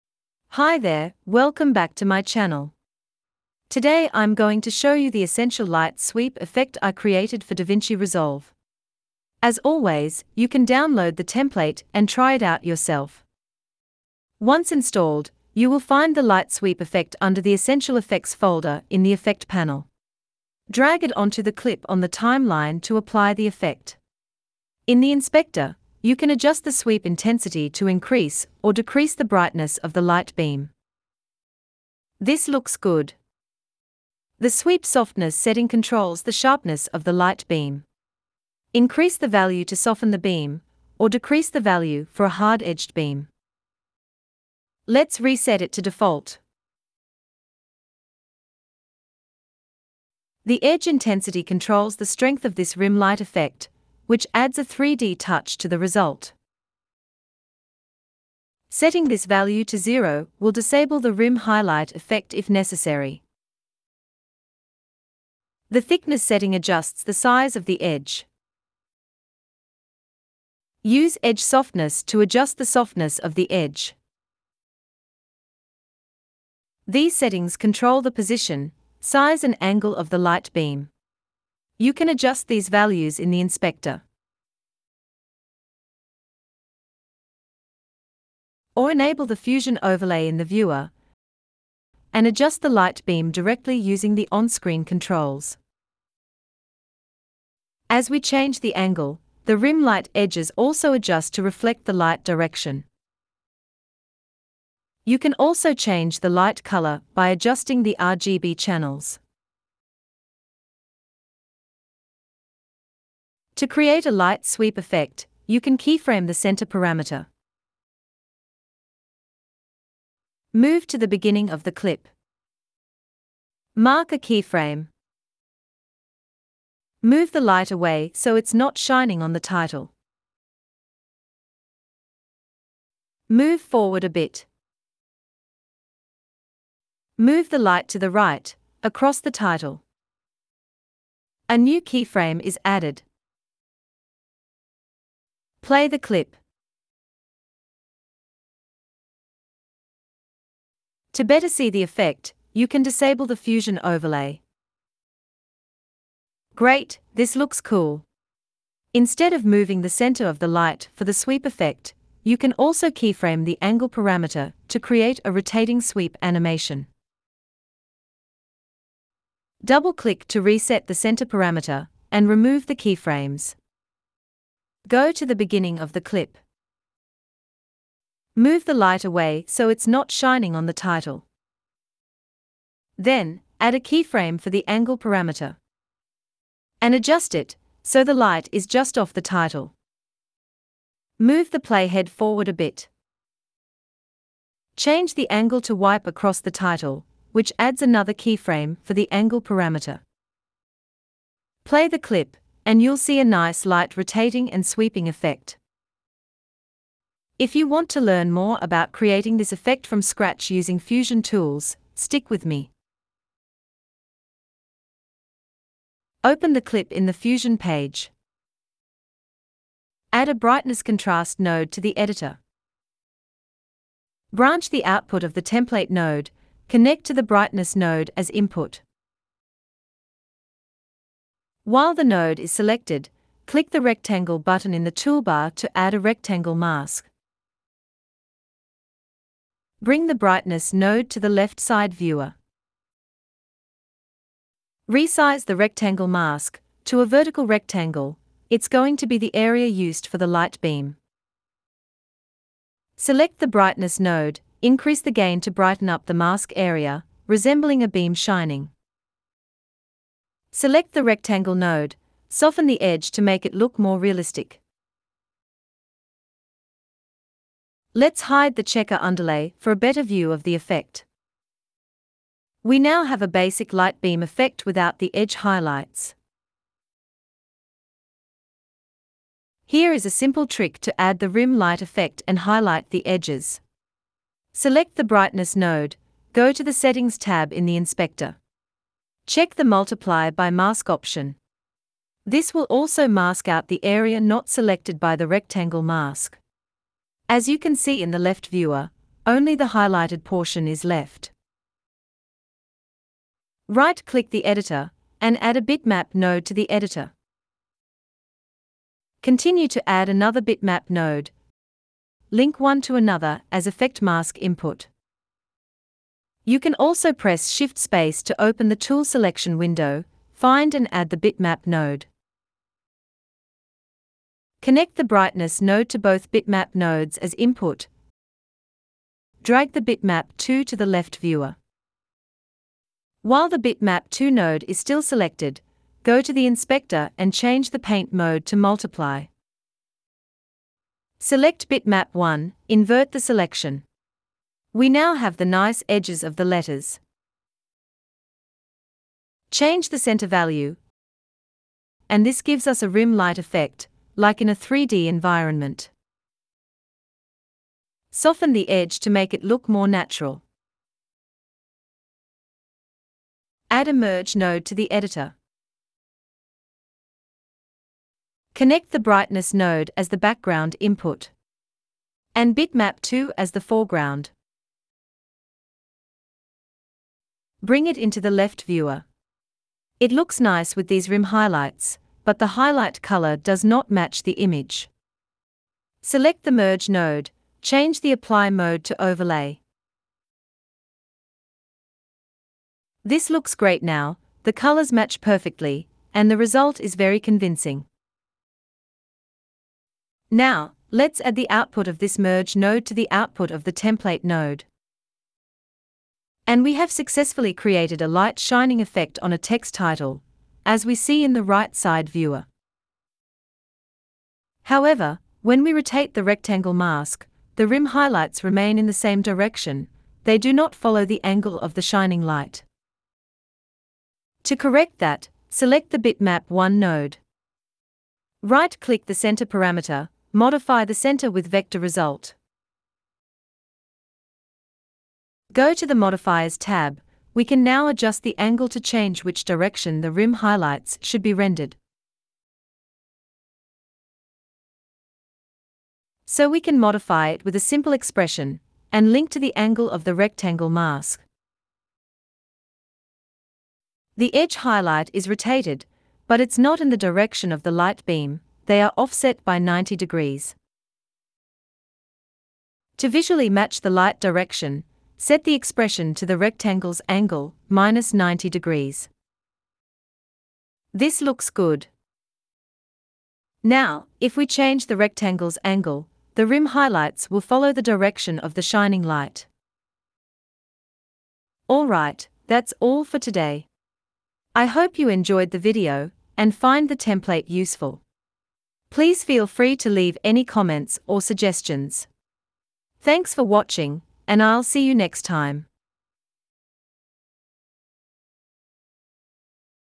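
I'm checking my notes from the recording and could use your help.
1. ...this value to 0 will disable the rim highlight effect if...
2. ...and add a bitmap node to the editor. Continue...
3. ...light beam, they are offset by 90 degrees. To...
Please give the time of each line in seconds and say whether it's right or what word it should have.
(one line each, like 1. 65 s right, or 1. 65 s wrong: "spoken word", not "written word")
1. 59 s right
2. 305 s right
3. 457 s right.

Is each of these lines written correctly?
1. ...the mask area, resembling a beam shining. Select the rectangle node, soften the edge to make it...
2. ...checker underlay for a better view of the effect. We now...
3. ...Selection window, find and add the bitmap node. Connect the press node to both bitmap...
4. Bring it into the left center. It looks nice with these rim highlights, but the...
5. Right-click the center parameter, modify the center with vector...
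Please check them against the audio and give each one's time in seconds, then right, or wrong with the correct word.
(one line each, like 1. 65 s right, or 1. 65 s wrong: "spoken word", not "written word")
1. 256 s right
2. 268 s right
3. 319 s wrong: "brightness", not "press"
4. 377 s wrong: "viewer", not "center"
5. 428 s right.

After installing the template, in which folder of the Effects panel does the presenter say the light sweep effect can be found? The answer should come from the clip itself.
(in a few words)
Essential Effects.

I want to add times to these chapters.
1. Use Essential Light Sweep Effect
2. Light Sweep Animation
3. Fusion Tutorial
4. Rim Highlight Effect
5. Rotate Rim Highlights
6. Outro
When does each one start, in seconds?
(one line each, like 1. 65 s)
1. 15 s
2. 113 s
3. 215 s
4. 280 s
5. 424 s
6. 481 s.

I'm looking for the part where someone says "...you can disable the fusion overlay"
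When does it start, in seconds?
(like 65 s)
152 s.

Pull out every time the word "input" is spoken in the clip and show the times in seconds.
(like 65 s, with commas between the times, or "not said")
228 s, 314 s, 327 s, 370 s.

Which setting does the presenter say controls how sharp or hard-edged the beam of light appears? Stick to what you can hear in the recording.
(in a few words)
Sweep softness.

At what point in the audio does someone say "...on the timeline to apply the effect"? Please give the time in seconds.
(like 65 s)
21 s.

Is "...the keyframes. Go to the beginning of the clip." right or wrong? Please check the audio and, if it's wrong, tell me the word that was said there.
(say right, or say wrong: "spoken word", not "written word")
right.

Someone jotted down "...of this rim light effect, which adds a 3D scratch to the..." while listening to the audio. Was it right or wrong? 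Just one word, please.
wrong.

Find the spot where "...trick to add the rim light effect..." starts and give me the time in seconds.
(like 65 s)
280 s.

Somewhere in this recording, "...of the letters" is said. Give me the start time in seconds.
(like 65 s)
346 s.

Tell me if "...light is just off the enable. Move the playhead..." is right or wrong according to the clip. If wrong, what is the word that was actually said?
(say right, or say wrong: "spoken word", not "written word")
wrong: "title", not "enable".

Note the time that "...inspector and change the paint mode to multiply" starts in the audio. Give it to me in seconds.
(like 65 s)
336 s.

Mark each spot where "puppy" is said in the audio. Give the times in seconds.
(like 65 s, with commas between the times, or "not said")
not said.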